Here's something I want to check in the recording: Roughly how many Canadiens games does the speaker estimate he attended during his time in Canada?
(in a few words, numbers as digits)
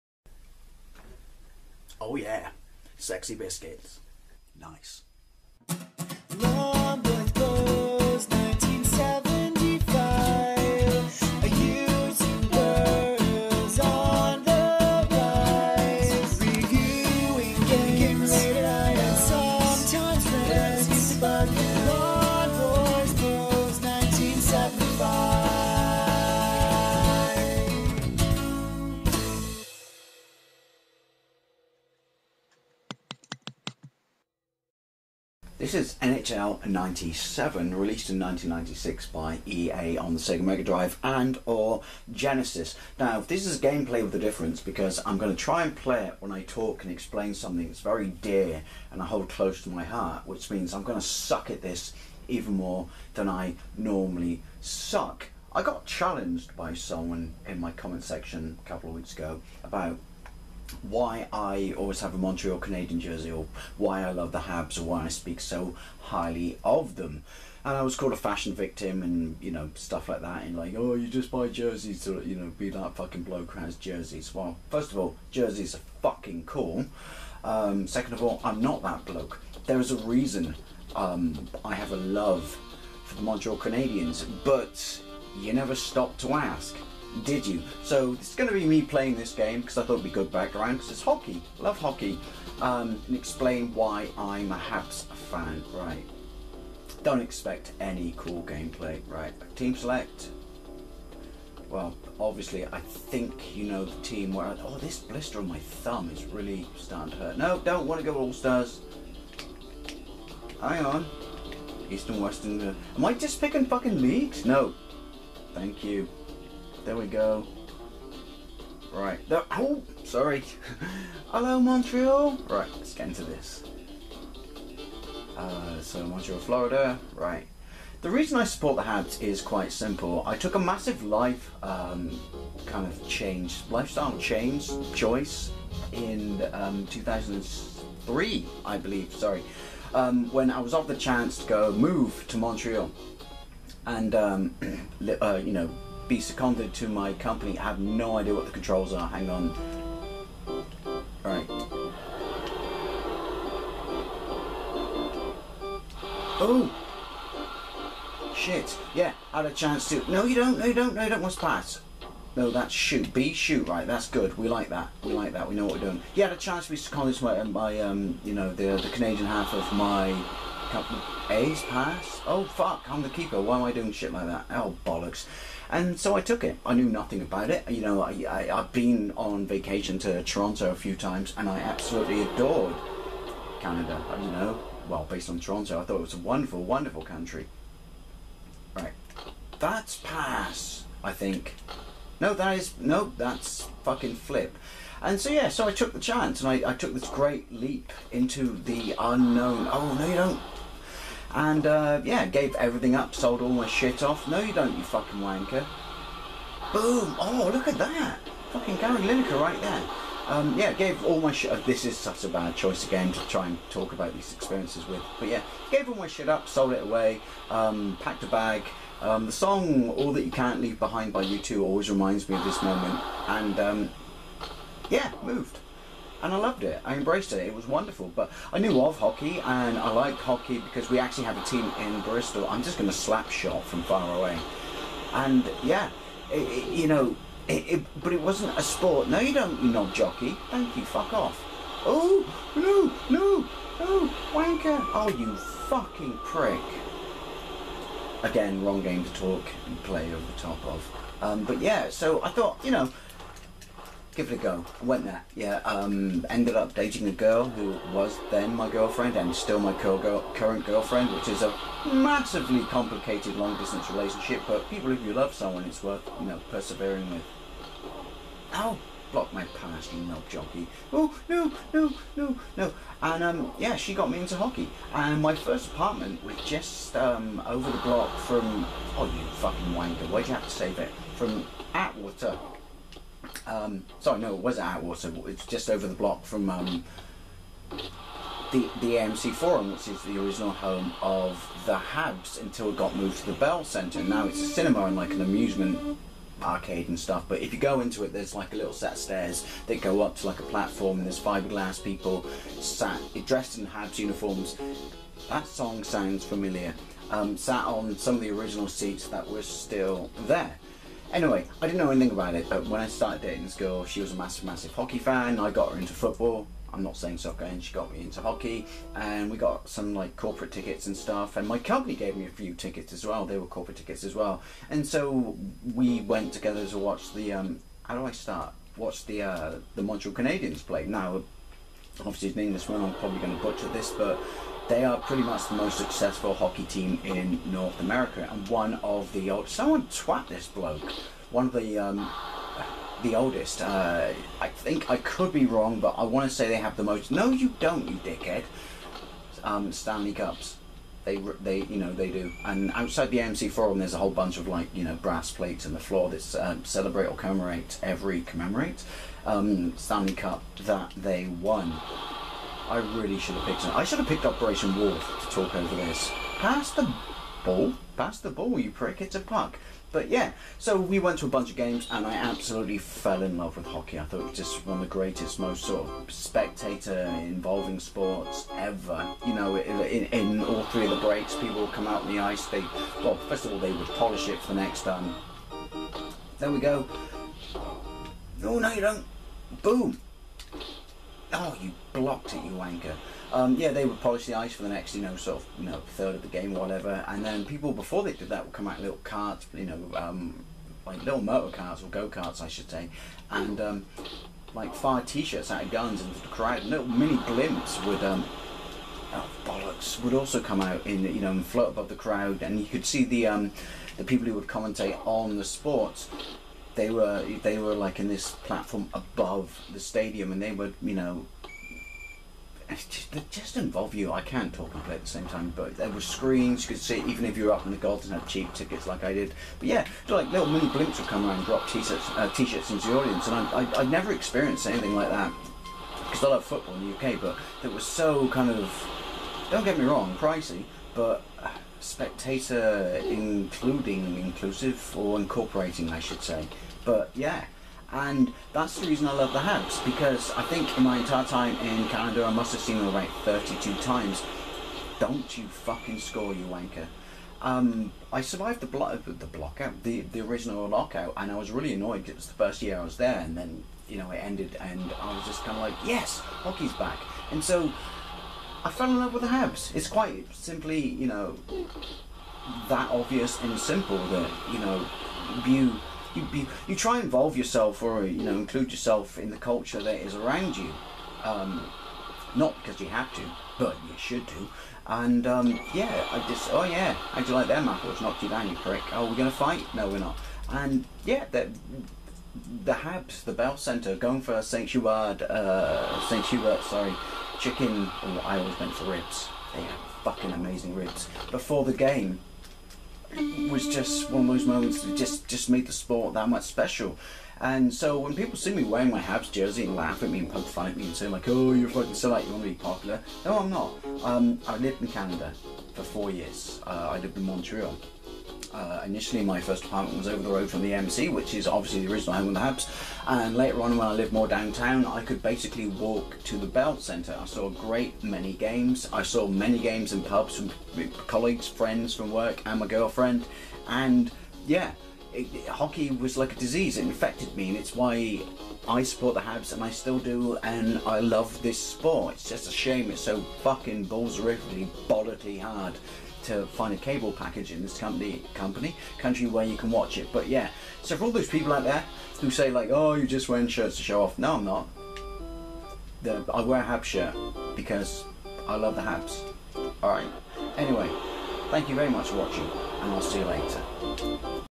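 32.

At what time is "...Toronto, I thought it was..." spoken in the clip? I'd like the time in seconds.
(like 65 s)
185 s.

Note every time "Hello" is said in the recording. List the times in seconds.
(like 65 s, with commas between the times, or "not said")
121 s.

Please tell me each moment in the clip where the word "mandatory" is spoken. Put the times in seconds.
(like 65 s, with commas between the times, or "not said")
not said.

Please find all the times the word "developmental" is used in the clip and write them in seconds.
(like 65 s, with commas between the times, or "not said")
not said.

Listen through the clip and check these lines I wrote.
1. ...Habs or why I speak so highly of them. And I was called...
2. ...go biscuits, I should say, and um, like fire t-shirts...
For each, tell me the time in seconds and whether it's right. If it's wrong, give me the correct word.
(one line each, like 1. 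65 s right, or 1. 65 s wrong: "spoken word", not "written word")
1. 64 s right
2. 401 s wrong: "karts", not "biscuits".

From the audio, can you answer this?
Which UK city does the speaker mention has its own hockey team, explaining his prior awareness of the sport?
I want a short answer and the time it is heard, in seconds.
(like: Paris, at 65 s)
Bristol, at 232 s.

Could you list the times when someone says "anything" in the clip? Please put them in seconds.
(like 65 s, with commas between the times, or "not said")
311 s, 434 s.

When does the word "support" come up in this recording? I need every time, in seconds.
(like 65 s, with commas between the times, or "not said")
128 s, 538 s.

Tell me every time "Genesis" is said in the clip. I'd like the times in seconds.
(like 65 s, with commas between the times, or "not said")
42 s.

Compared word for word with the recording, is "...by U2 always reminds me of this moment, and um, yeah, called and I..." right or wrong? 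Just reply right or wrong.
wrong.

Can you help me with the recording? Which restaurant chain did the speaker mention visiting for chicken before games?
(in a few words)
Saint Hubert.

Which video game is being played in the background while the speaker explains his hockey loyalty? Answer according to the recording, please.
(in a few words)
NHL 97.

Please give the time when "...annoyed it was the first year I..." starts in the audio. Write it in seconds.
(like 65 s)
461 s.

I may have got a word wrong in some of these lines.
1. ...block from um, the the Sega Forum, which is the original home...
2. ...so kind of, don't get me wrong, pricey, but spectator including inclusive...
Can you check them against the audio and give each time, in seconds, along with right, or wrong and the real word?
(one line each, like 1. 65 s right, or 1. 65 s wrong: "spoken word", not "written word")
1. 285 s wrong: "AMC", not "Sega"
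2. 437 s right.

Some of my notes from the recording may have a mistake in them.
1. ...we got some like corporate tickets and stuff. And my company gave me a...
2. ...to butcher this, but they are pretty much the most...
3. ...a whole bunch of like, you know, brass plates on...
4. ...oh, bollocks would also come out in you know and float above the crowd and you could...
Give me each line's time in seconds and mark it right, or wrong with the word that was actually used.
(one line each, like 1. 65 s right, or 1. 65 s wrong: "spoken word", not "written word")
1. 319 s right
2. 333 s right
3. 353 s right
4. 409 s right.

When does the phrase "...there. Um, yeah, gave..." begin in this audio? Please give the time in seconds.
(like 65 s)
209 s.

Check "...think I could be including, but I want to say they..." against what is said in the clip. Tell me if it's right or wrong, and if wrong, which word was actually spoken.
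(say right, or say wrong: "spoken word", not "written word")
wrong: "wrong", not "including".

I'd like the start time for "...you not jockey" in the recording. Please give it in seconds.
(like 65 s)
239 s.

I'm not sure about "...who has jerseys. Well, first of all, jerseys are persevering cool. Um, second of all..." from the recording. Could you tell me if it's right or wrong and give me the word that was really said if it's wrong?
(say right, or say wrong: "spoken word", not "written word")
wrong: "fucking", not "persevering".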